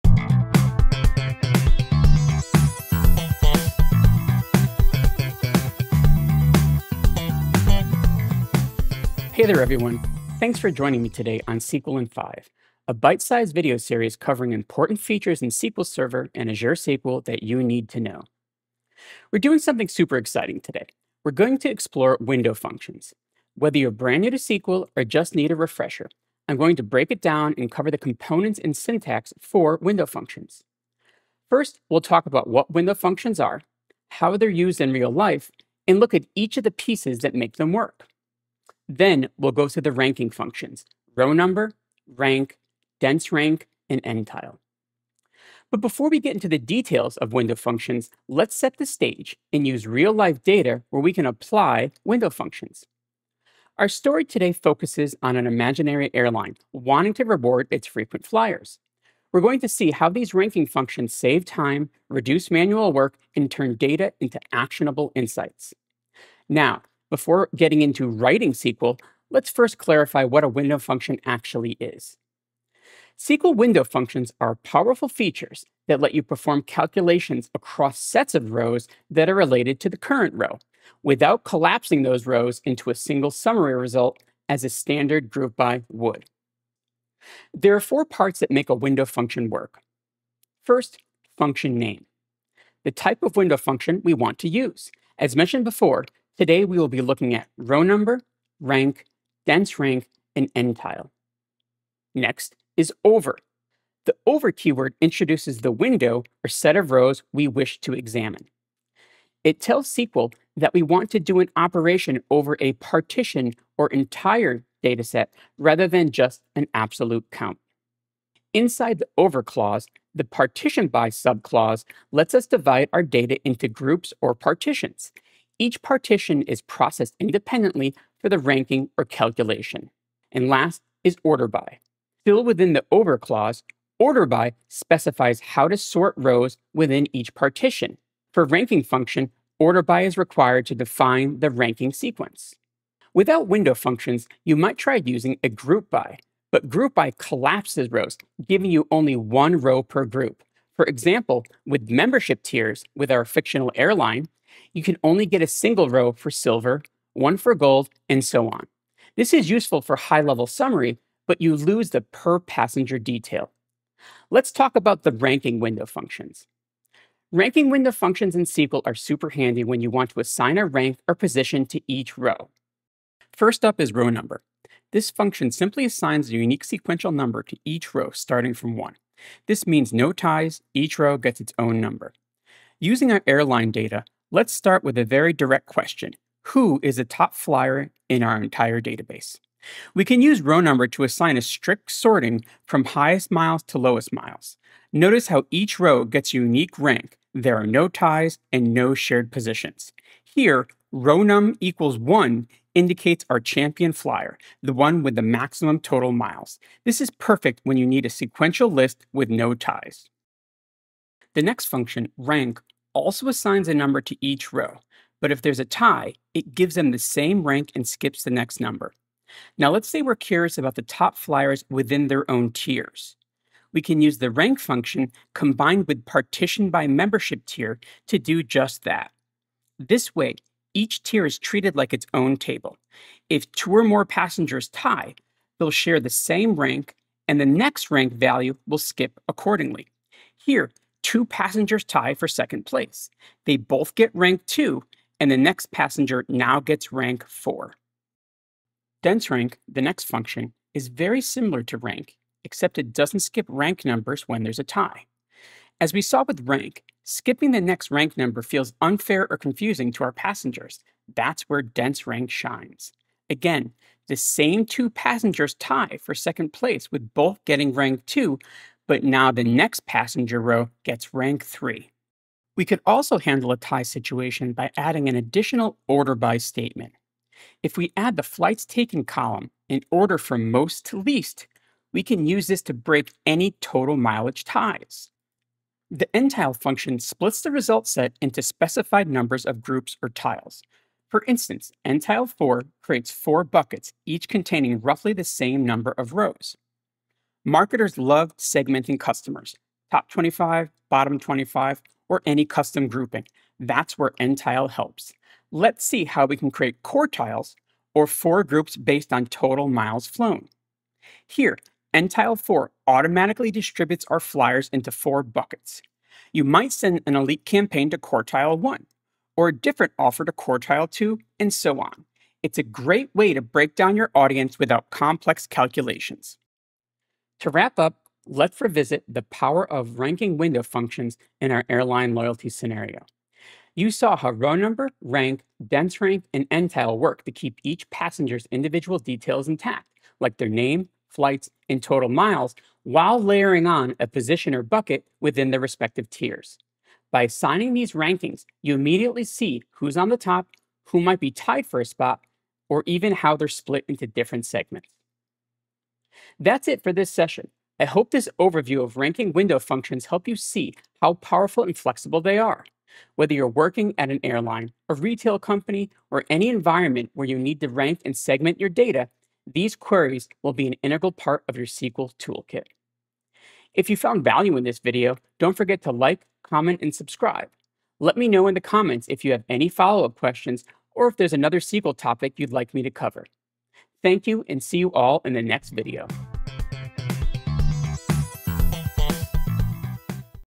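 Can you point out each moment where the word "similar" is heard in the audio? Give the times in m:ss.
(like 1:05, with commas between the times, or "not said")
4:11.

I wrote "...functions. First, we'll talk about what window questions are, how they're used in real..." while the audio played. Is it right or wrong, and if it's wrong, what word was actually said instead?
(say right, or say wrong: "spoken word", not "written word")
wrong: "functions", not "questions".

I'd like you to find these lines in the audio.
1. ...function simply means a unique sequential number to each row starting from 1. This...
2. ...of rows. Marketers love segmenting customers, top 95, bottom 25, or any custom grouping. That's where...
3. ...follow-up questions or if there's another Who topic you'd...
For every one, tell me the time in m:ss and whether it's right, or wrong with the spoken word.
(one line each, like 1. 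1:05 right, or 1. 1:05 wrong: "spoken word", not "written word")
1. 2:55 wrong: "assigns", not "means"
2. 4:55 wrong: "25", not "95"
3. 6:19 wrong: "SQL", not "Who".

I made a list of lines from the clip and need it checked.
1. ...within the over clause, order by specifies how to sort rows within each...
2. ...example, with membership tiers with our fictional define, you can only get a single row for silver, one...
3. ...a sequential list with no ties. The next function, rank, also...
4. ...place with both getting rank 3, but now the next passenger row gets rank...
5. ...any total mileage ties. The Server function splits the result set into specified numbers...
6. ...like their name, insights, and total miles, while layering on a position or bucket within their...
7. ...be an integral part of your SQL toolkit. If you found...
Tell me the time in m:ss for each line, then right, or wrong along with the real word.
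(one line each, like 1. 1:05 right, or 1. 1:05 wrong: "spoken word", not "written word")
1. 2:12 right
2. 2:30 wrong: "airline", not "define"
3. 3:28 right
4. 4:26 wrong: "2", not "3"
5. 4:43 wrong: "NTILE", not "Server"
6. 5:40 wrong: "flights", not "insights"
7. 6:10 right.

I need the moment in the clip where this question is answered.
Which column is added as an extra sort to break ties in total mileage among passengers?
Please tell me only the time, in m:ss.
4:38.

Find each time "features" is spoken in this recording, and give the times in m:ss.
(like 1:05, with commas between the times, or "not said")
0:14, 1:15.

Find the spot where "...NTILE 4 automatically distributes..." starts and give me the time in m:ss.
5:11.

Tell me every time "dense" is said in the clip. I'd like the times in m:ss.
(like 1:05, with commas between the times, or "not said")
0:42, 1:39, 4:09, 4:21, 5:35.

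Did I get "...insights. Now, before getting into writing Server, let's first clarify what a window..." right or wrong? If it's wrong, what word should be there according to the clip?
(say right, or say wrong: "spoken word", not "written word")
wrong: "SQL", not "Server".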